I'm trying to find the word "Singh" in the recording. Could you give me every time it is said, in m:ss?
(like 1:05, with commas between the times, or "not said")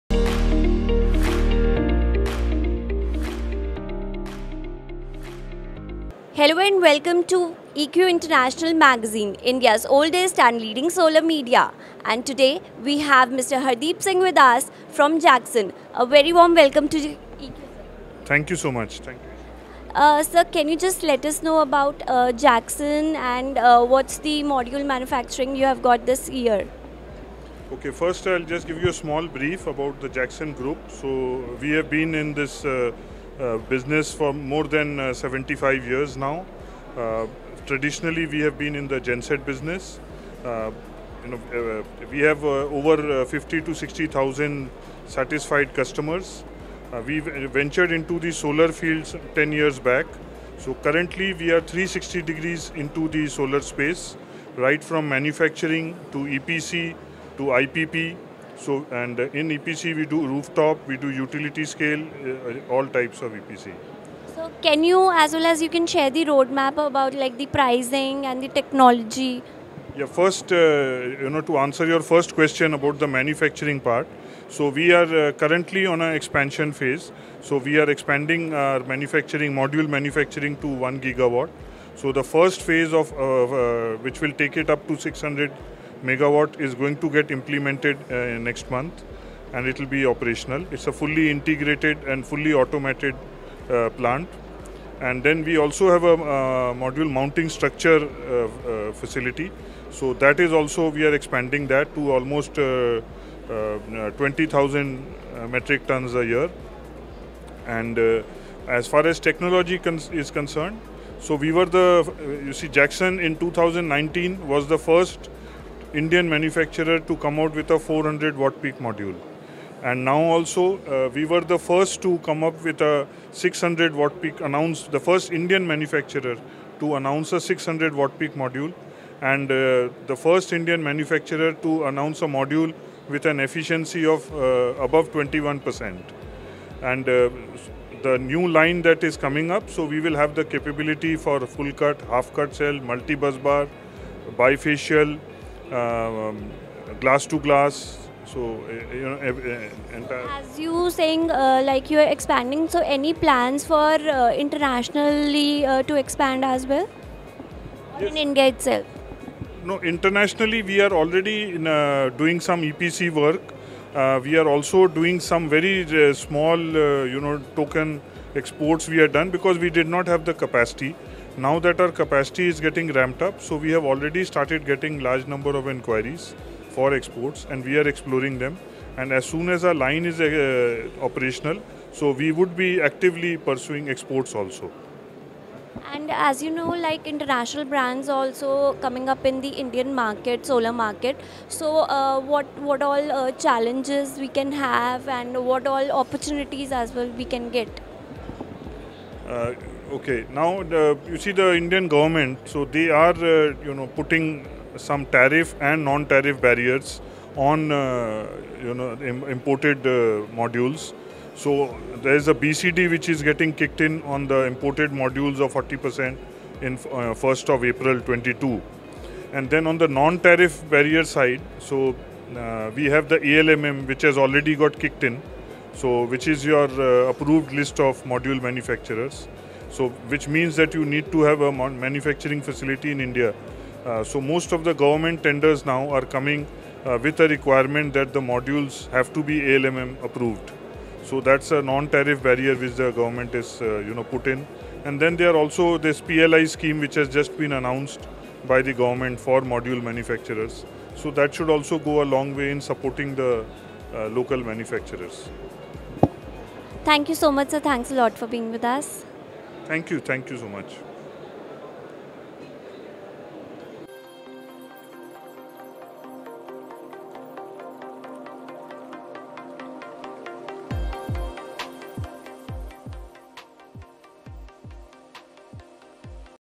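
0:14.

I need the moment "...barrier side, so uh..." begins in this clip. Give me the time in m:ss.
3:40.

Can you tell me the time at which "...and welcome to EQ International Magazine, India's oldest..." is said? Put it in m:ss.
0:06.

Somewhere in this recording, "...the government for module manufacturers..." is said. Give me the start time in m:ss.
4:08.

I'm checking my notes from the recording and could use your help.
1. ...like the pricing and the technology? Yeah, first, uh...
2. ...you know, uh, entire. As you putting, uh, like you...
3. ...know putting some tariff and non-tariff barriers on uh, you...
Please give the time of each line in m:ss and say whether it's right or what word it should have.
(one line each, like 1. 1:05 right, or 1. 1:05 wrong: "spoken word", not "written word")
1. 1:07 right
2. 2:28 wrong: "saying", not "putting"
3. 3:23 right.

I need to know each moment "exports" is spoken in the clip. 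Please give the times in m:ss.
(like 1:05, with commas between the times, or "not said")
2:48, 2:56, 3:03.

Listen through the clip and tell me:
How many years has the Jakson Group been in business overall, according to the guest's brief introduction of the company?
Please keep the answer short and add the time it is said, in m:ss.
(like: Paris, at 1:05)
75 years, at 0:35.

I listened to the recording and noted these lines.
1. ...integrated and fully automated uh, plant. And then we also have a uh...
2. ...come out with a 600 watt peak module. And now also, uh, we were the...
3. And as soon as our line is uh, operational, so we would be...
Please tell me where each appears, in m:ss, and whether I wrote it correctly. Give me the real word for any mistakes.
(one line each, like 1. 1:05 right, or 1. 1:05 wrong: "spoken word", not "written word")
1. 1:31 right
2. 1:57 wrong: "400", not "600"
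3. 2:58 right.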